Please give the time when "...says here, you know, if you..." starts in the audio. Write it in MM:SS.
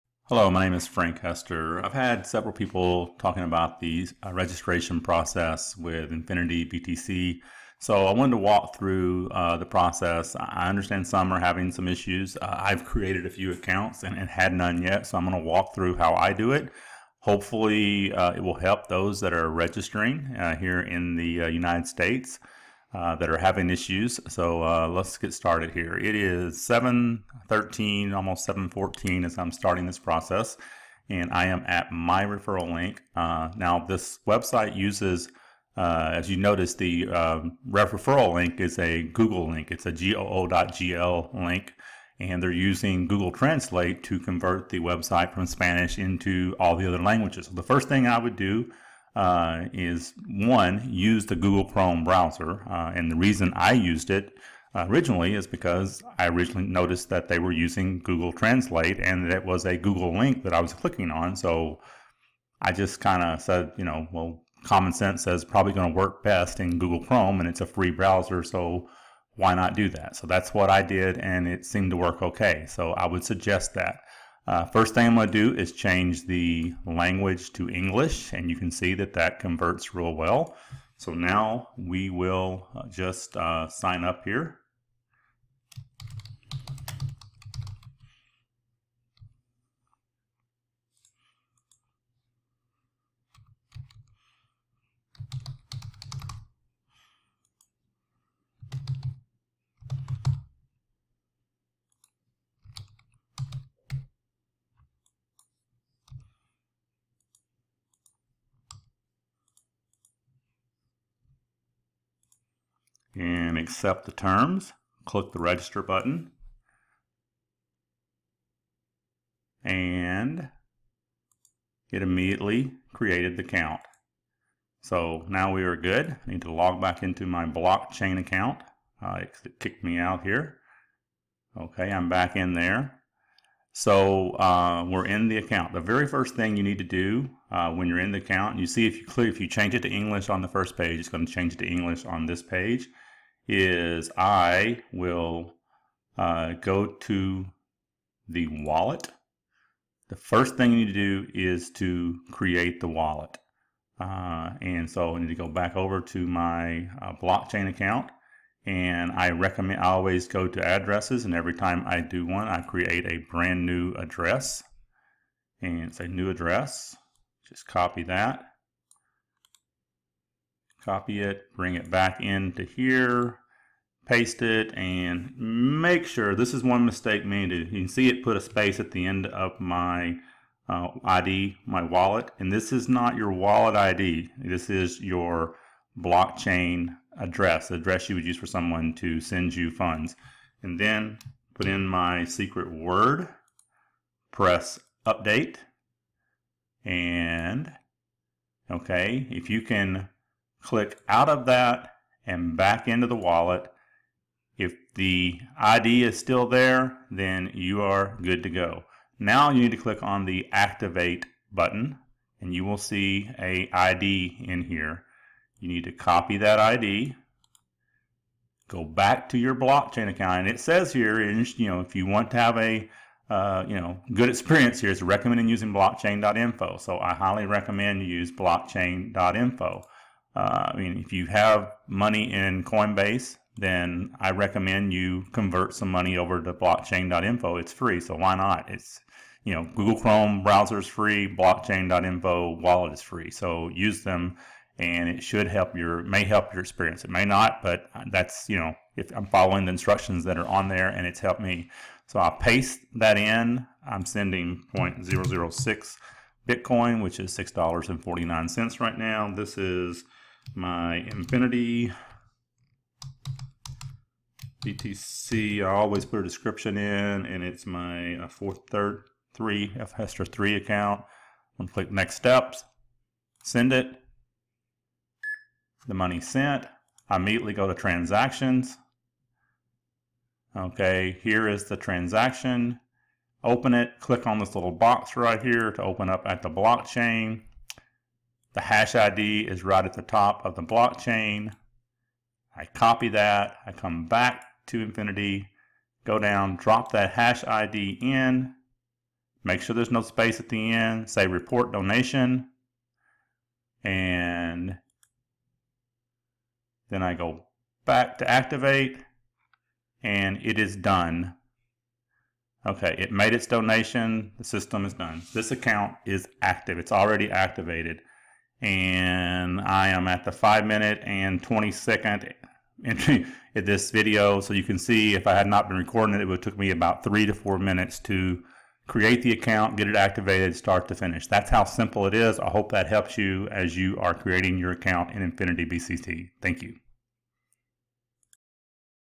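03:40.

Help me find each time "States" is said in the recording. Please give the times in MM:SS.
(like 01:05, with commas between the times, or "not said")
00:21.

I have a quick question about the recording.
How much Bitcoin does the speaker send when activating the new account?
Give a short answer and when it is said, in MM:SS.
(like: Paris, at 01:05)
0.006 Bitcoin, at 04:14.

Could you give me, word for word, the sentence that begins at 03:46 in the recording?
So I highly recommend you use blockchain.info.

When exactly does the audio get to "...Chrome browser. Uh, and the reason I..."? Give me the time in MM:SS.
00:51.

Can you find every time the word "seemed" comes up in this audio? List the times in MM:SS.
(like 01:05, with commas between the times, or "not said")
01:11.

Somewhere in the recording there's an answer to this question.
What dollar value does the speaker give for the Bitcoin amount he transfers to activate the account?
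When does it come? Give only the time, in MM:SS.
04:17.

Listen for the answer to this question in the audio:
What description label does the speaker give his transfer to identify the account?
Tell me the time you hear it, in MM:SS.
04:29.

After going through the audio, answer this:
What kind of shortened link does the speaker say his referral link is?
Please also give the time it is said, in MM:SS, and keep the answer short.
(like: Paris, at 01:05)
goo.gl link, at 00:39.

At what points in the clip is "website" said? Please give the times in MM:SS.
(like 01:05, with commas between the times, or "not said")
00:34, 00:44.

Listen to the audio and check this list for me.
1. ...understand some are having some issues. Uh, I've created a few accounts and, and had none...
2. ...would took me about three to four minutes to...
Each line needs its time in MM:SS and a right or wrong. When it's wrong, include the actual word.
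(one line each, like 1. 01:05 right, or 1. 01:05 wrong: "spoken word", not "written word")
1. 00:10 right
2. 05:26 right.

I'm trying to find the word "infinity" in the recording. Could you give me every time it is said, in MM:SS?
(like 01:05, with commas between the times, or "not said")
00:06, 04:20, 04:54, 05:35.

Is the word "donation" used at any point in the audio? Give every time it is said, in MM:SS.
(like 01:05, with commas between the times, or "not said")
05:01, 05:13.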